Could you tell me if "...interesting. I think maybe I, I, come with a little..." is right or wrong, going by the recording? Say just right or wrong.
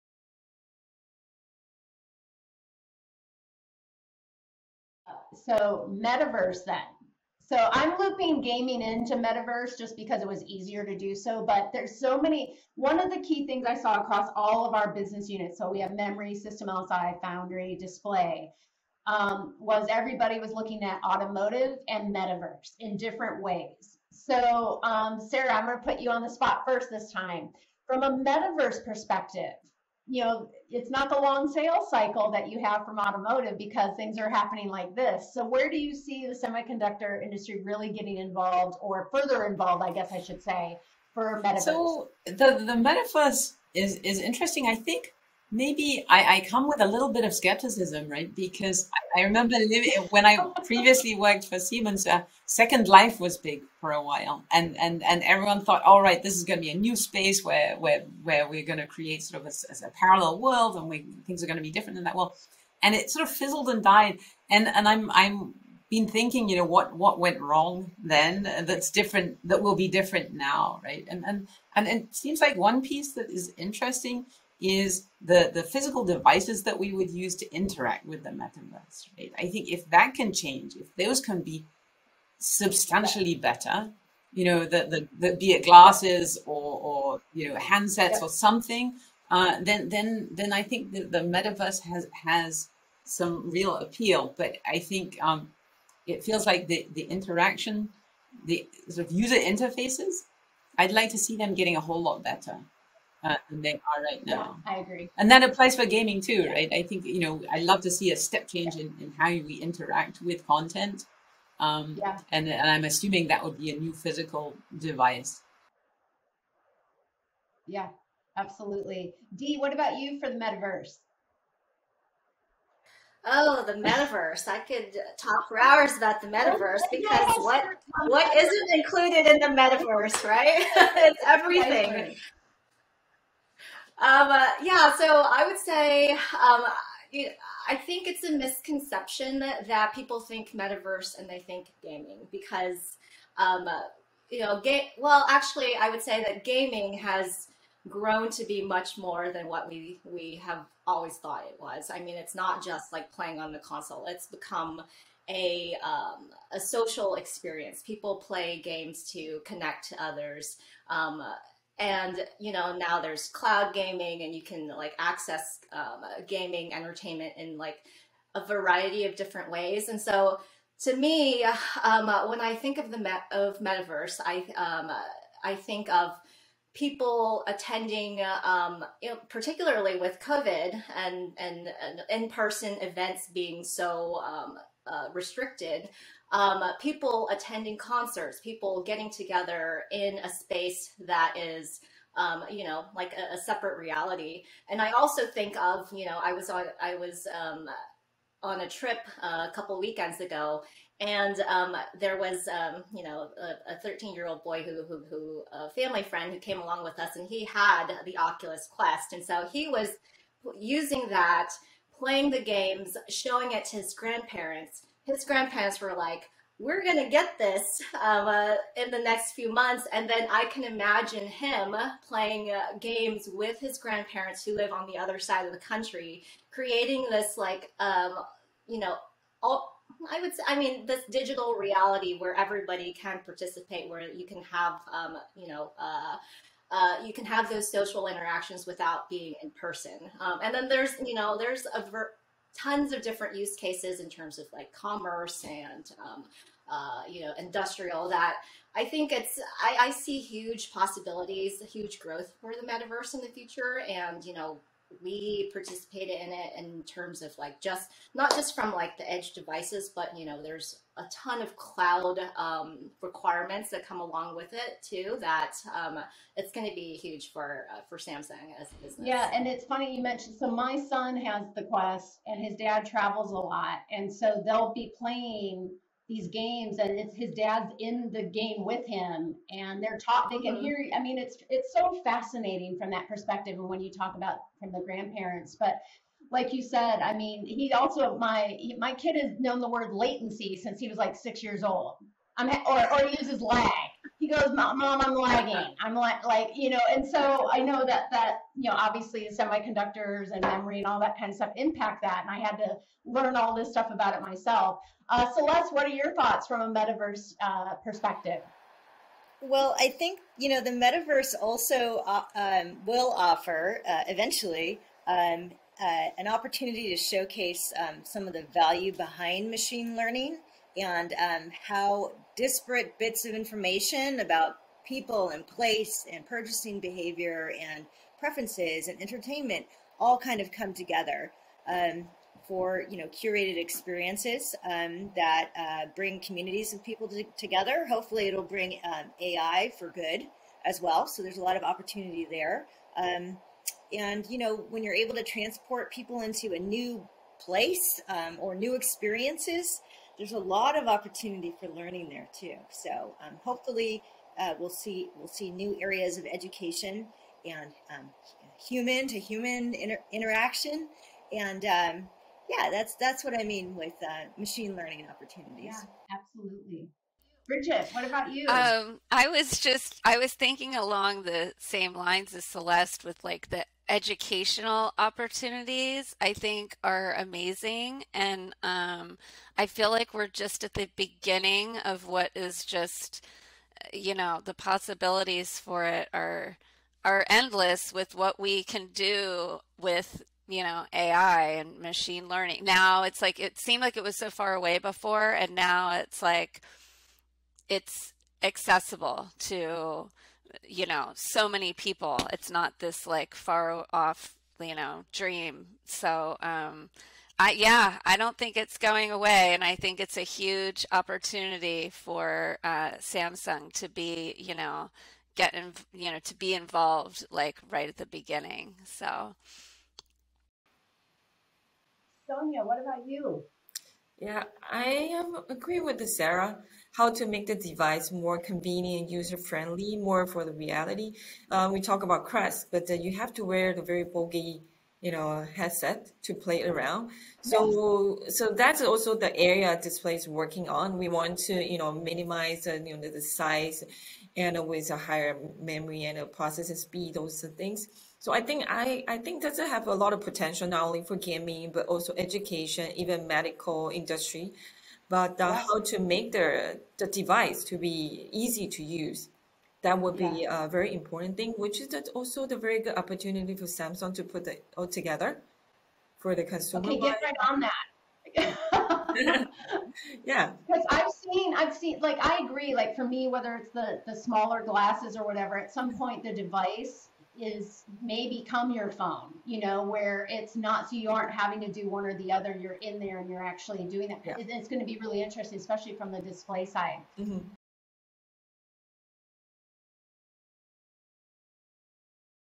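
right.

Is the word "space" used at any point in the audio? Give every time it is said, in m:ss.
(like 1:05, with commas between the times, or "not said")
0:56, 3:10.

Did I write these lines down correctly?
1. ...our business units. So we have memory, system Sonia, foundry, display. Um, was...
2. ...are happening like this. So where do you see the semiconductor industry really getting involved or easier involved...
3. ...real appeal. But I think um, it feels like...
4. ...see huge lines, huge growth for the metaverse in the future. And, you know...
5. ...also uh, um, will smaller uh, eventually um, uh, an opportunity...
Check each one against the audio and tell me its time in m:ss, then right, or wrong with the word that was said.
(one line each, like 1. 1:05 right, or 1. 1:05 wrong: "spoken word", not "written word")
1. 0:14 wrong: "LSI", not "Sonia"
2. 0:34 wrong: "further", not "easier"
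3. 1:33 right
4. 4:09 wrong: "possibilities", not "lines"
5. 5:11 wrong: "offer", not "smaller".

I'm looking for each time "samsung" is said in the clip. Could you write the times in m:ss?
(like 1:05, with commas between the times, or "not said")
4:27, 6:52, 7:43.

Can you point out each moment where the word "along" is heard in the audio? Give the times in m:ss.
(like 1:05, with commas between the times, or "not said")
3:26, 4:24, 6:10.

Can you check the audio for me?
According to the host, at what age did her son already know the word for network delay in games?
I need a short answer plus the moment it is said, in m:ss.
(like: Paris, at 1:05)
6, at 4:51.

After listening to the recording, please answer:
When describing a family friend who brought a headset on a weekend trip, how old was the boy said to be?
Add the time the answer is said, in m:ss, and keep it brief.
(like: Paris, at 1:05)
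13, at 3:23.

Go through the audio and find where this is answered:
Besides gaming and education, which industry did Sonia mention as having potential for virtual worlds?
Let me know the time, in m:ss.
7:33.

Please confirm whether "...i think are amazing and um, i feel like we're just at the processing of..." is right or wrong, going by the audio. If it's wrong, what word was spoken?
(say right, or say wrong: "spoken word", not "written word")
wrong: "beginning", not "processing".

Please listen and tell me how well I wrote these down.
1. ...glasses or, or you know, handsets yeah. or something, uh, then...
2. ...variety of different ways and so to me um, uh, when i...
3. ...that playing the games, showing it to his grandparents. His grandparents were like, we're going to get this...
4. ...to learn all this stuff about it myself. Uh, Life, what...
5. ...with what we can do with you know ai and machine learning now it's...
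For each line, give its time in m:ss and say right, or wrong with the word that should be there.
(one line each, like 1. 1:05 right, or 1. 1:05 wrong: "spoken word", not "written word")
1. 1:25 right
2. 2:48 right
3. 3:31 right
4. 5:02 wrong: "Celeste", not "Life"
5. 6:27 right.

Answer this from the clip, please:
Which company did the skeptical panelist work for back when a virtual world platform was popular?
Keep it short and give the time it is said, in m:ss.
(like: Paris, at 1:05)
Siemens, at 0:51.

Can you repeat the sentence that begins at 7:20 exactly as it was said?
We want to, you know, minimize, uh, you know, the size and with a higher memory and a processing speed, those things.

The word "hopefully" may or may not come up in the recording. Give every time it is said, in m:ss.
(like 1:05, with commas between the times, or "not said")
5:37, 5:53.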